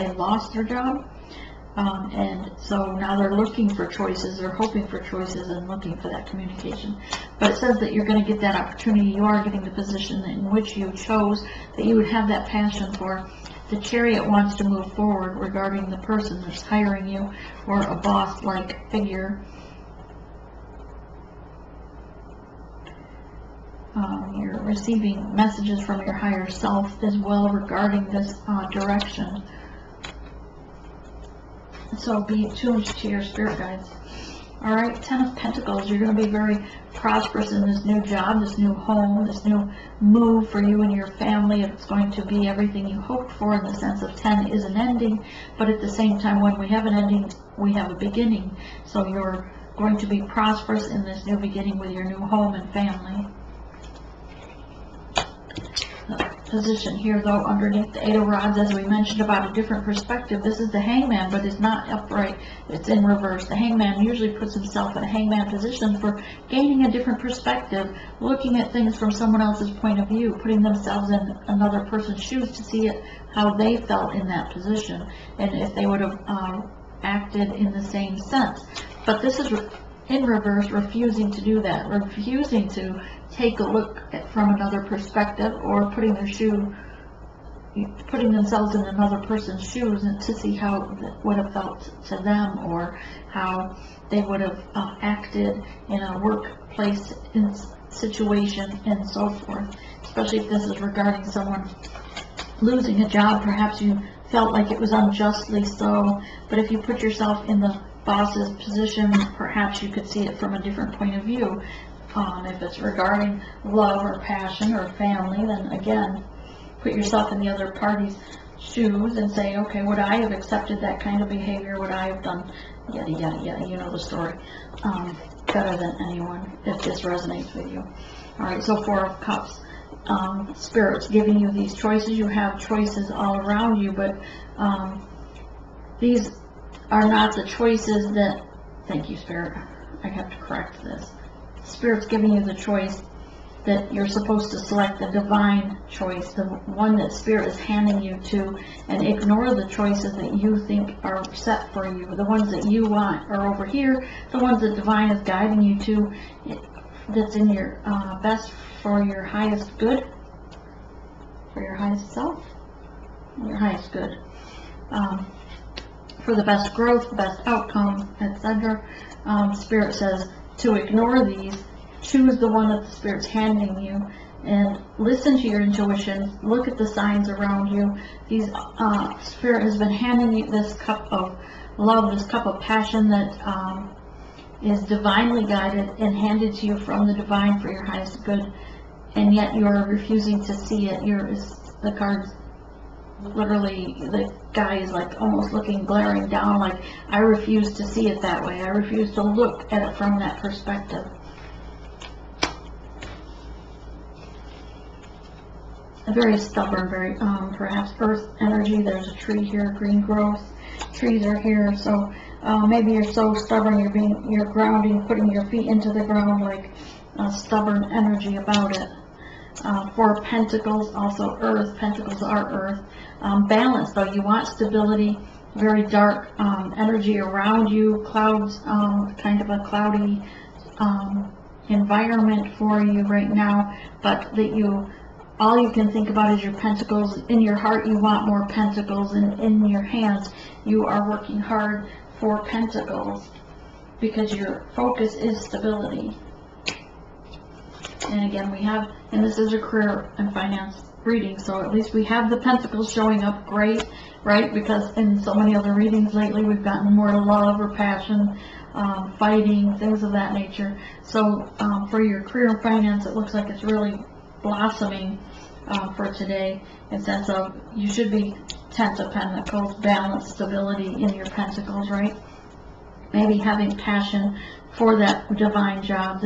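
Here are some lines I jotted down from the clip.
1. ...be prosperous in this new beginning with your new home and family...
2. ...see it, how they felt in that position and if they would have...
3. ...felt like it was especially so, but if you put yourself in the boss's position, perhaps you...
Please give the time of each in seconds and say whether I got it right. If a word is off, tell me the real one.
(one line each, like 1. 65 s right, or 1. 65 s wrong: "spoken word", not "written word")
1. 50 s right
2. 72 s right
3. 104 s wrong: "unjustly", not "especially".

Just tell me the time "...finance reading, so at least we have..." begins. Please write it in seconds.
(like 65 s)
250 s.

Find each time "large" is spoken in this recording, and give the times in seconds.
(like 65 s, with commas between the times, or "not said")
not said.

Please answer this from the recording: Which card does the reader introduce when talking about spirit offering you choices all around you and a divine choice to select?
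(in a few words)
Four of Cups.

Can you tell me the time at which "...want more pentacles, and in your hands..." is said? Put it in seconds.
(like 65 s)
237 s.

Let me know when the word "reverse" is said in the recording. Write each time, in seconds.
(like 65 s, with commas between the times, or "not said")
63 s, 80 s.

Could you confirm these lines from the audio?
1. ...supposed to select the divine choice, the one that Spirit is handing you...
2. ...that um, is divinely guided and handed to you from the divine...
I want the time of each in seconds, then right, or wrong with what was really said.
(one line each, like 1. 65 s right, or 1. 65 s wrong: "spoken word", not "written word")
1. 144 s right
2. 183 s right.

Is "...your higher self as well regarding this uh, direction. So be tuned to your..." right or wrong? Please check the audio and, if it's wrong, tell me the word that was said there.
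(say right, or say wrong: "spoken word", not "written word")
right.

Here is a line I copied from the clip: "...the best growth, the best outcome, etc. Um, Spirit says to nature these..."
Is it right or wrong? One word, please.
wrong.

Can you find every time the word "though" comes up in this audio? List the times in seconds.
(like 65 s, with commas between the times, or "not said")
57 s, 223 s.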